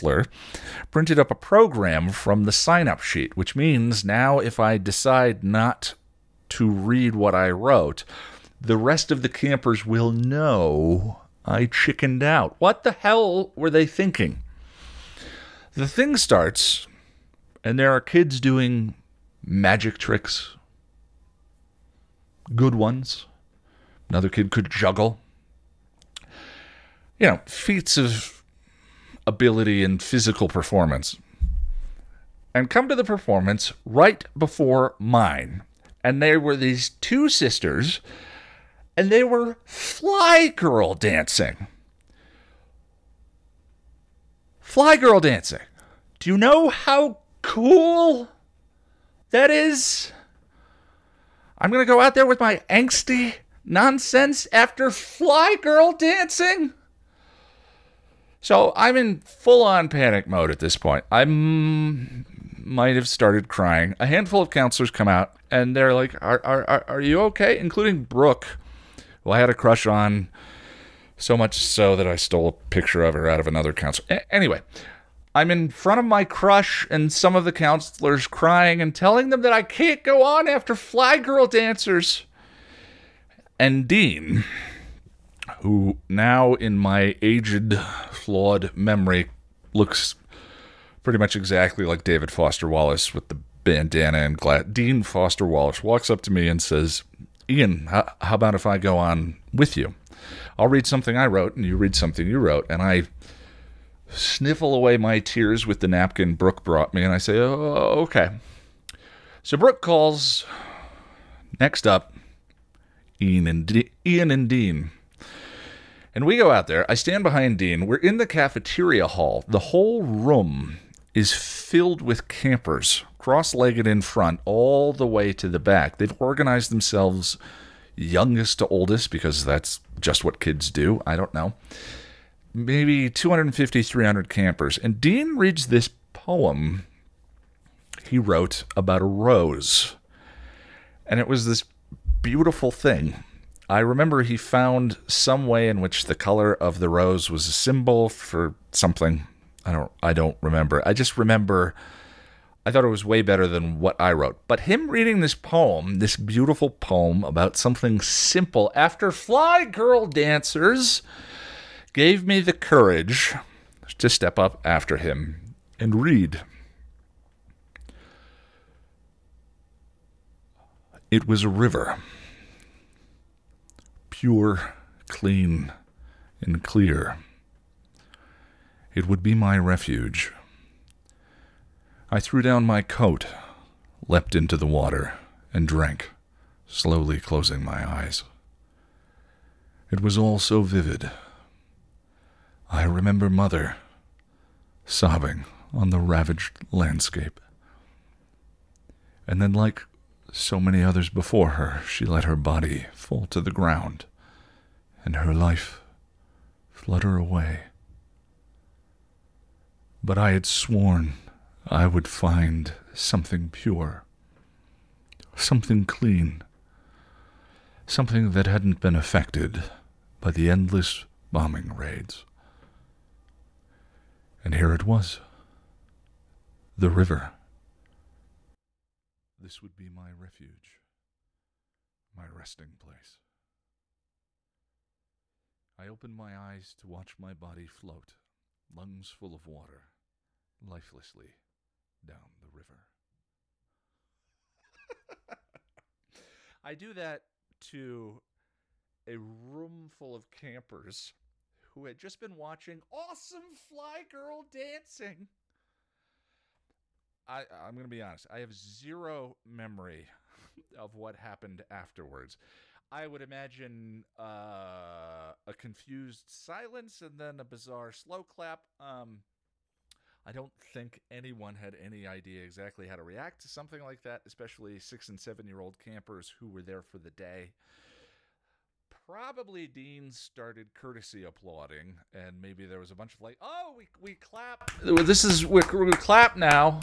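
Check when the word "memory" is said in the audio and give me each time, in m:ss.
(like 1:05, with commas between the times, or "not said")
1:28, 4:19.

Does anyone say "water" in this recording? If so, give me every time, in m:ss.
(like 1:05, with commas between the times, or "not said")
3:04, 3:59.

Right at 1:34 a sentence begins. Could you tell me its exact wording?
Dean Foster Wallace walks up to me and says, Ian, how about if I go on with you?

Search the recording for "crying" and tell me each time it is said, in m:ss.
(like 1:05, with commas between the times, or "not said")
1:03, 1:18.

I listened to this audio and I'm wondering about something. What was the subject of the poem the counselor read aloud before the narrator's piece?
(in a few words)
A rose.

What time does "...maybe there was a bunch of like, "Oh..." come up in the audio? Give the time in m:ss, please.
4:42.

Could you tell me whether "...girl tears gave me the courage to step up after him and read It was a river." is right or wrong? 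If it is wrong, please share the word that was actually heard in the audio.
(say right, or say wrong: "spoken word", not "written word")
wrong: "dancers", not "tears".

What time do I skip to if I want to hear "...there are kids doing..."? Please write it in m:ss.
0:17.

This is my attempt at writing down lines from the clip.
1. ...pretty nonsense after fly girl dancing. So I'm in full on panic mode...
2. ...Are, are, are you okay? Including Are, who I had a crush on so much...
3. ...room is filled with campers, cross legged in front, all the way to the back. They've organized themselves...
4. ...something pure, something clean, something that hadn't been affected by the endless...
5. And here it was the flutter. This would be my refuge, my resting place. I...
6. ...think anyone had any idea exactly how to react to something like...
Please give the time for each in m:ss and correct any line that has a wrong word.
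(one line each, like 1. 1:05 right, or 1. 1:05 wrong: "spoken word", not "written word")
1. 0:52 wrong: "angsty", not "pretty"
2. 1:06 wrong: "Brooke", not "Are"
3. 2:00 right
4. 3:32 right
5. 3:44 wrong: "river", not "flutter"
6. 4:30 right.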